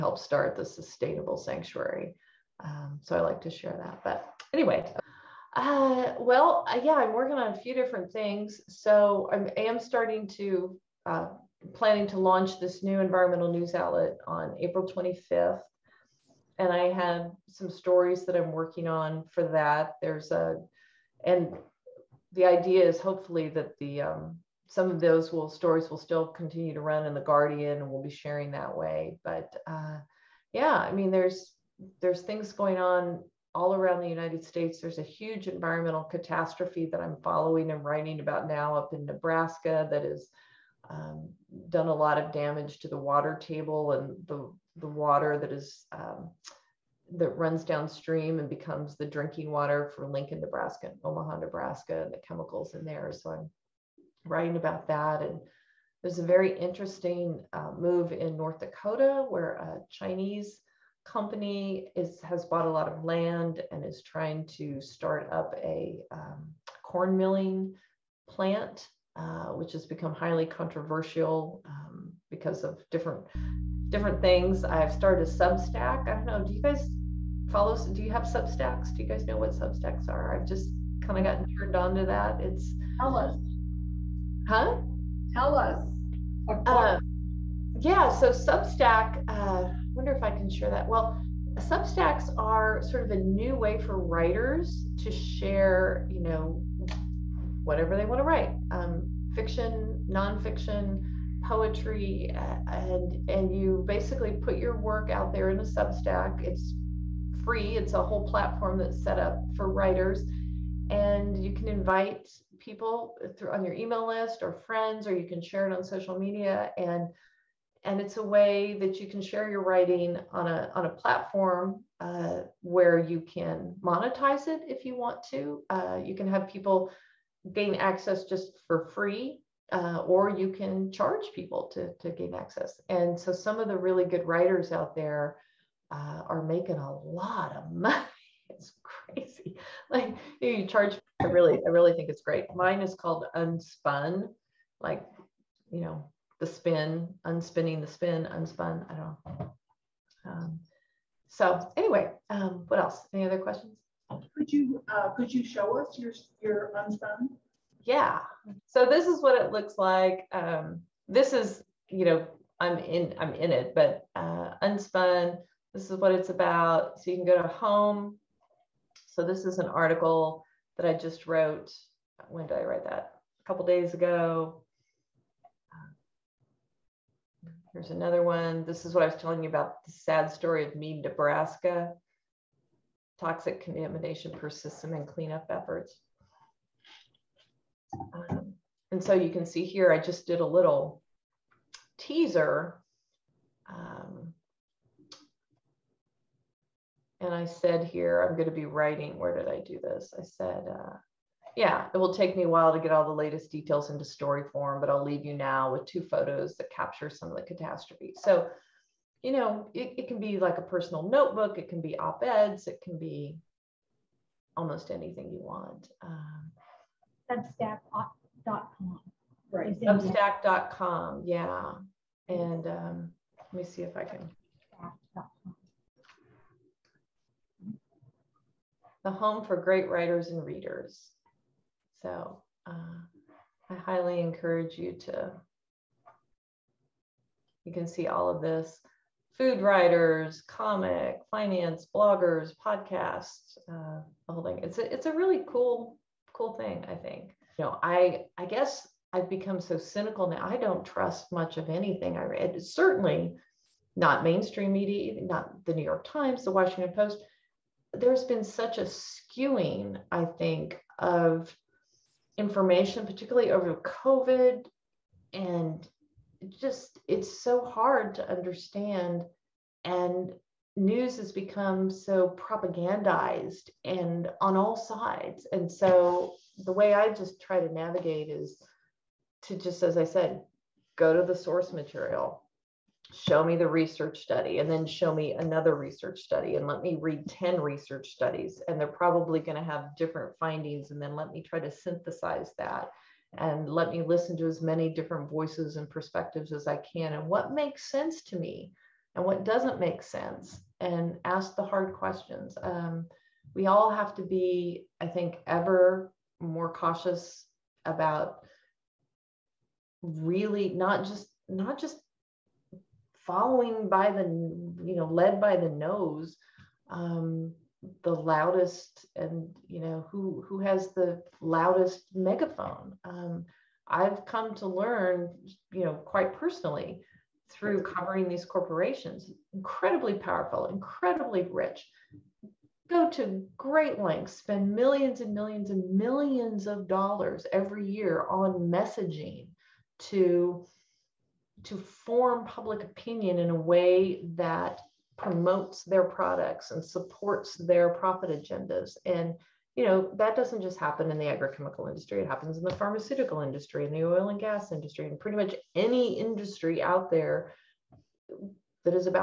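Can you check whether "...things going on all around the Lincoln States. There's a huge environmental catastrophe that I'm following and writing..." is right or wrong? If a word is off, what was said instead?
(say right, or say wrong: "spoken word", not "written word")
wrong: "United", not "Lincoln".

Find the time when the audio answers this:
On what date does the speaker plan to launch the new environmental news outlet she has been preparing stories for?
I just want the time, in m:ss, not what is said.
0:14.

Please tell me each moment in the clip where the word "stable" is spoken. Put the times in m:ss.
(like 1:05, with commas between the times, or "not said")
not said.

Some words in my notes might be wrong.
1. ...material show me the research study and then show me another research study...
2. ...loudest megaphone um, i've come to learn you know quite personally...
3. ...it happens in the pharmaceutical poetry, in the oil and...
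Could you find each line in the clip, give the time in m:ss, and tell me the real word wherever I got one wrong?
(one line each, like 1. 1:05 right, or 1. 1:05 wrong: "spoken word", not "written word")
1. 4:41 right
2. 5:21 right
3. 5:52 wrong: "industry", not "poetry".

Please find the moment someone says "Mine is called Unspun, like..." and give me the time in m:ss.
2:22.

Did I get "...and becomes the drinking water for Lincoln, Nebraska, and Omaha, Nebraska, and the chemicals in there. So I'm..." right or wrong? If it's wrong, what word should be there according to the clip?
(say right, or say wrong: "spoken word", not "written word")
right.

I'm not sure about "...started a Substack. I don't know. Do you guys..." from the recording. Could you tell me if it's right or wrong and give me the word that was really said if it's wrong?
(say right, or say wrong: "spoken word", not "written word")
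right.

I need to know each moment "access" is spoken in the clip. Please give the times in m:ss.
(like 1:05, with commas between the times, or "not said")
2:07, 2:12.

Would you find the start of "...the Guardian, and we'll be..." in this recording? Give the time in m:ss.
0:27.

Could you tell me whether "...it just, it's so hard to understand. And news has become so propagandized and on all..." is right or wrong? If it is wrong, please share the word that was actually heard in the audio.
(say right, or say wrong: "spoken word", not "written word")
right.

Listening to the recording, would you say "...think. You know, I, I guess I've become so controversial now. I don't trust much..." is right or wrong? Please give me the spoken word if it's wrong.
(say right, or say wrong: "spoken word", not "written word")
wrong: "cynical", not "controversial".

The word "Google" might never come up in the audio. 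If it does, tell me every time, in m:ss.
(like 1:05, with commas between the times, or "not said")
not said.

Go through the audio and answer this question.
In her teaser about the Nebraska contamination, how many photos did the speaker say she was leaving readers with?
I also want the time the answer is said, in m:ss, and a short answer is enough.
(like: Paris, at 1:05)
2, at 3:25.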